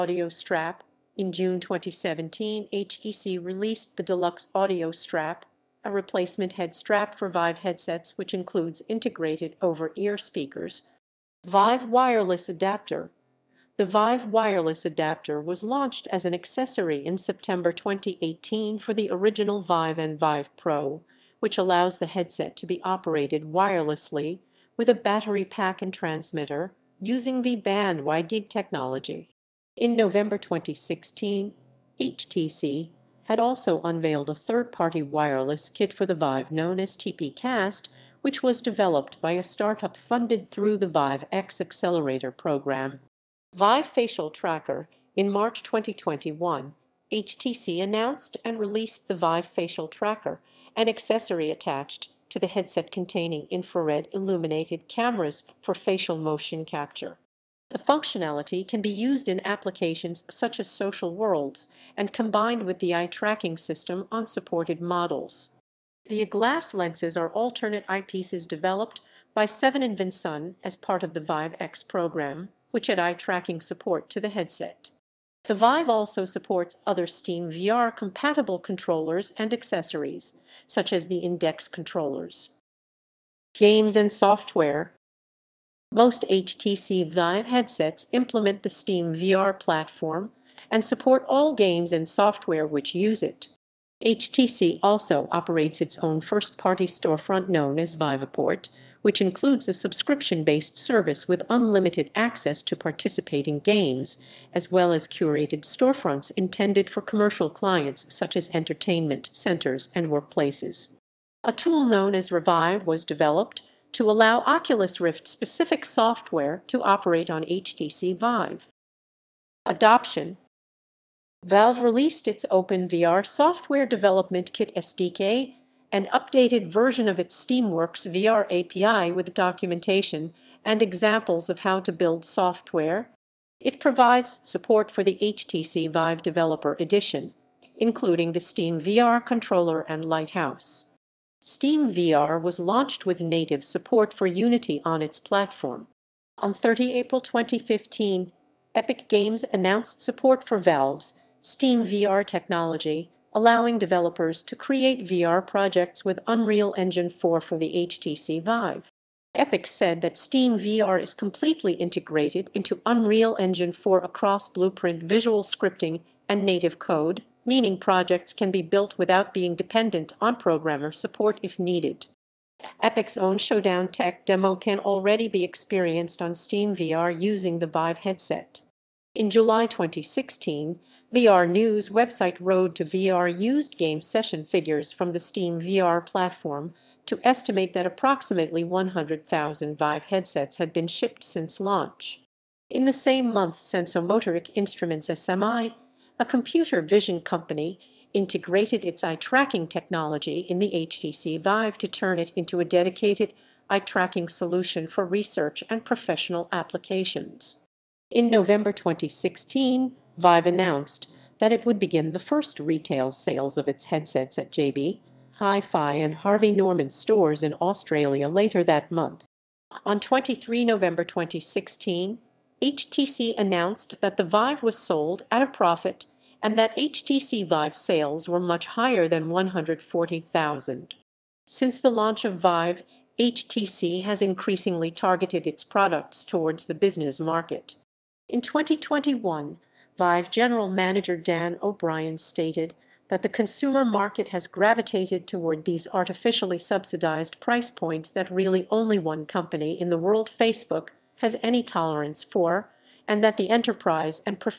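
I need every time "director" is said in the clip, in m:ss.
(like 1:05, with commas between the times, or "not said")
not said.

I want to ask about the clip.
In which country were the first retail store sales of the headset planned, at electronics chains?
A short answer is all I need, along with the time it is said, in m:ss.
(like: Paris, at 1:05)
Australia, at 3:37.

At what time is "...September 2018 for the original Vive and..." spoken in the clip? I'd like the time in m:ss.
0:17.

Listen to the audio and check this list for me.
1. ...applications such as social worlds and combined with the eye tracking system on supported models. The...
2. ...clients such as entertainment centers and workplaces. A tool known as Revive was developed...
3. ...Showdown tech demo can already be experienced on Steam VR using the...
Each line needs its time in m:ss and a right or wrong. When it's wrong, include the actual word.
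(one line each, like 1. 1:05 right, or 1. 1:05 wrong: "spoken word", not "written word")
1. 0:59 right
2. 1:47 right
3. 2:53 right.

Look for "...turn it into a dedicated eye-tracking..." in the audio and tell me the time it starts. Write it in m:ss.
3:21.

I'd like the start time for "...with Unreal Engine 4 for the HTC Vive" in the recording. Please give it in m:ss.
2:36.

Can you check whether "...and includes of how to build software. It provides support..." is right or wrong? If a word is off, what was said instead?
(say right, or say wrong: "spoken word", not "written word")
wrong: "examples", not "includes".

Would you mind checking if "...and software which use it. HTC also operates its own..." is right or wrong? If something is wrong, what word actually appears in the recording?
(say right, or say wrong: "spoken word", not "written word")
right.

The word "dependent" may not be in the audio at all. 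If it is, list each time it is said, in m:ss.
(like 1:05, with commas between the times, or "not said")
2:49.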